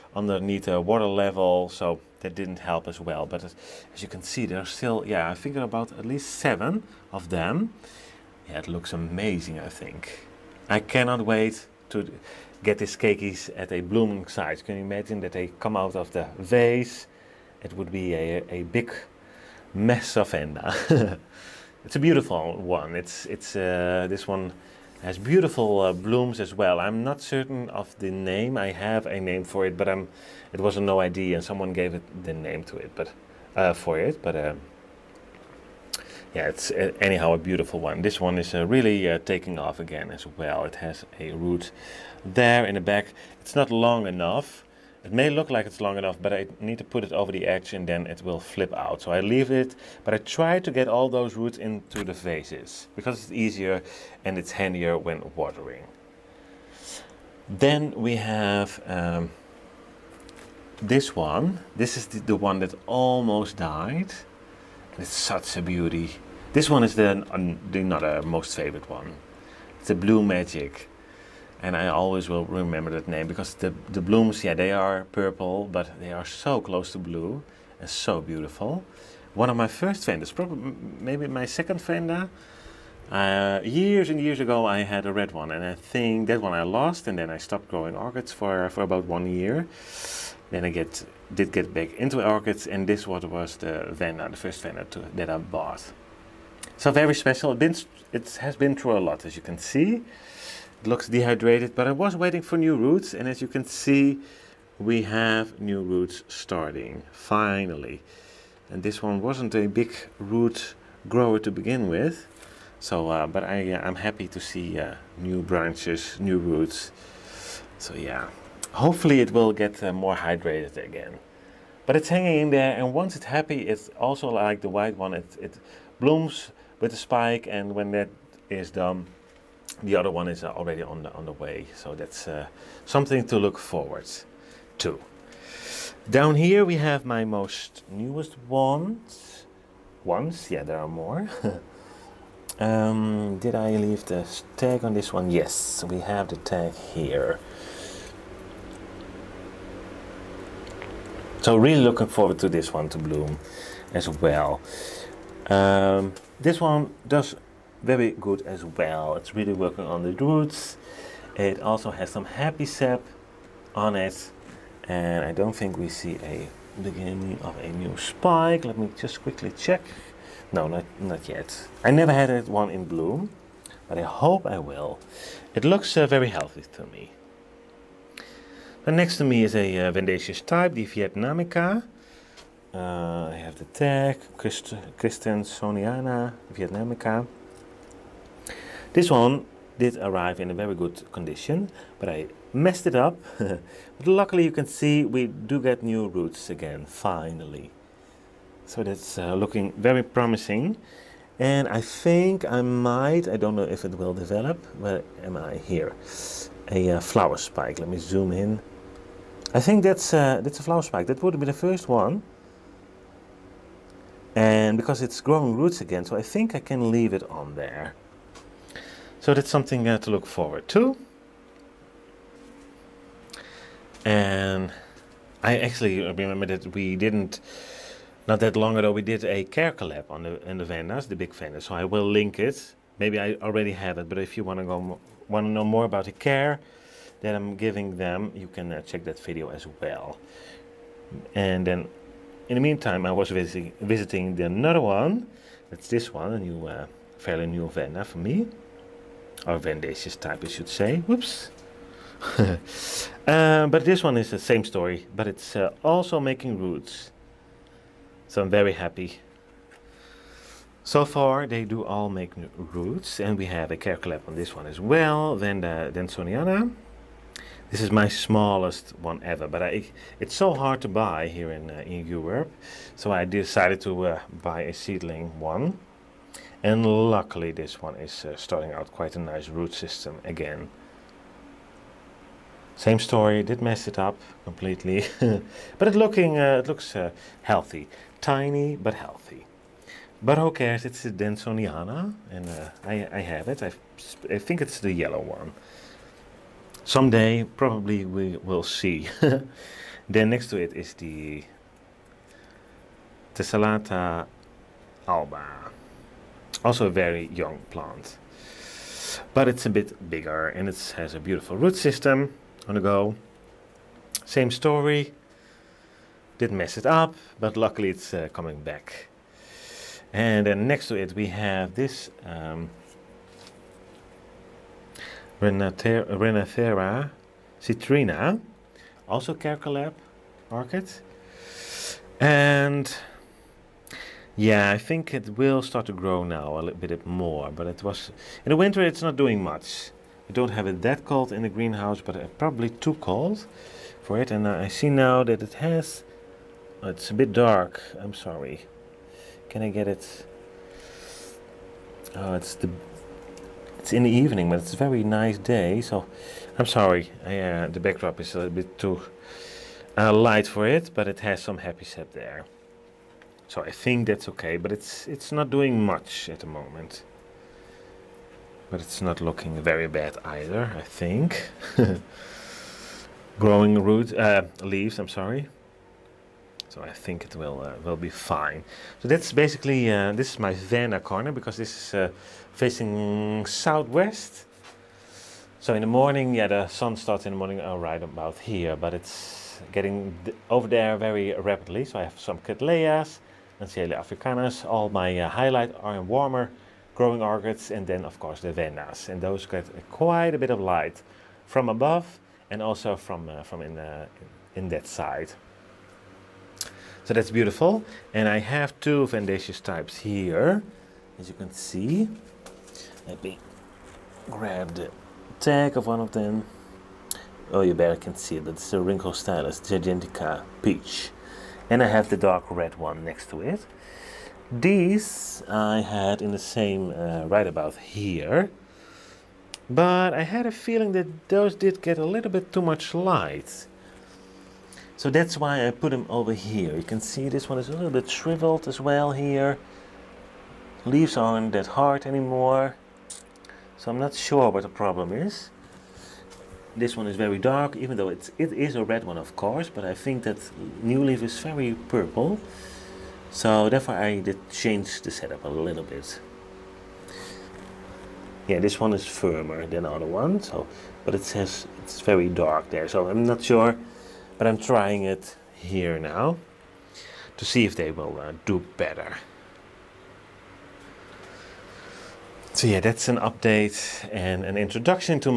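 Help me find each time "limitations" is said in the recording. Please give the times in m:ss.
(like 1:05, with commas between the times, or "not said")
not said.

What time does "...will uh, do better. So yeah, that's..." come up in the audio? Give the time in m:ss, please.
7:47.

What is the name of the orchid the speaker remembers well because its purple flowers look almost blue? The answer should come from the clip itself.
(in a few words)
Blue Magic.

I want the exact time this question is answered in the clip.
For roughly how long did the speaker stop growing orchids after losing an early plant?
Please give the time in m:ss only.
1:28.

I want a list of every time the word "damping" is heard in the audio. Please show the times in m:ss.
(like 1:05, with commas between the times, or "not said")
not said.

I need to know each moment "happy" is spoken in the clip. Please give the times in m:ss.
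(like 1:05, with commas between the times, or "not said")
1:53, 2:03, 2:42, 4:18, 6:01.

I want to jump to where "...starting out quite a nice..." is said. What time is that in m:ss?
4:38.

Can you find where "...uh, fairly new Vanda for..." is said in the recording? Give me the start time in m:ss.
4:06.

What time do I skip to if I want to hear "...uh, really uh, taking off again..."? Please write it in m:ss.
0:38.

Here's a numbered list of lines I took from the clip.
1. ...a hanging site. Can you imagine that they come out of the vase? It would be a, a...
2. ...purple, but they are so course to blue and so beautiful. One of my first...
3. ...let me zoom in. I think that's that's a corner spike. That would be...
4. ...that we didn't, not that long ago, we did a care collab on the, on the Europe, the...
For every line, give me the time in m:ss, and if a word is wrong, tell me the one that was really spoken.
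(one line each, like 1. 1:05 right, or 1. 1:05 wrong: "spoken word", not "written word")
1. 0:13 wrong: "blooming", not "hanging"
2. 1:15 wrong: "close", not "course"
3. 3:27 wrong: "flower", not "corner"
4. 3:46 wrong: "Vandas", not "Europe".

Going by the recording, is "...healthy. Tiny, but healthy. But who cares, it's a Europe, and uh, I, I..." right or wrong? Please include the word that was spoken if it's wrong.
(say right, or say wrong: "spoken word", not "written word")
wrong: "Denisoniana", not "Europe".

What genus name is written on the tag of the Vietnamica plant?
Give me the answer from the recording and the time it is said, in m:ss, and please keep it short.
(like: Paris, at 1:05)
Christensonia, at 3:04.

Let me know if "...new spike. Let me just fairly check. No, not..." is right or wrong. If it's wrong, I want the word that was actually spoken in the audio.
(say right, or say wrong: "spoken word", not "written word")
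wrong: "quickly", not "fairly".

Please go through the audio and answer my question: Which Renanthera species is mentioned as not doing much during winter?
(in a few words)
Citrina.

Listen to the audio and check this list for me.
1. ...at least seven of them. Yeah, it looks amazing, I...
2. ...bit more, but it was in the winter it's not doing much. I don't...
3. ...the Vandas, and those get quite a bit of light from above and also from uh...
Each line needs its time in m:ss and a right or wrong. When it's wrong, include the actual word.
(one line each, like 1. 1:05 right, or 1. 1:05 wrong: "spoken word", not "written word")
1. 0:05 right
2. 5:36 right
3. 6:38 right.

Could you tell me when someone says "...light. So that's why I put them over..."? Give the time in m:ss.
7:12.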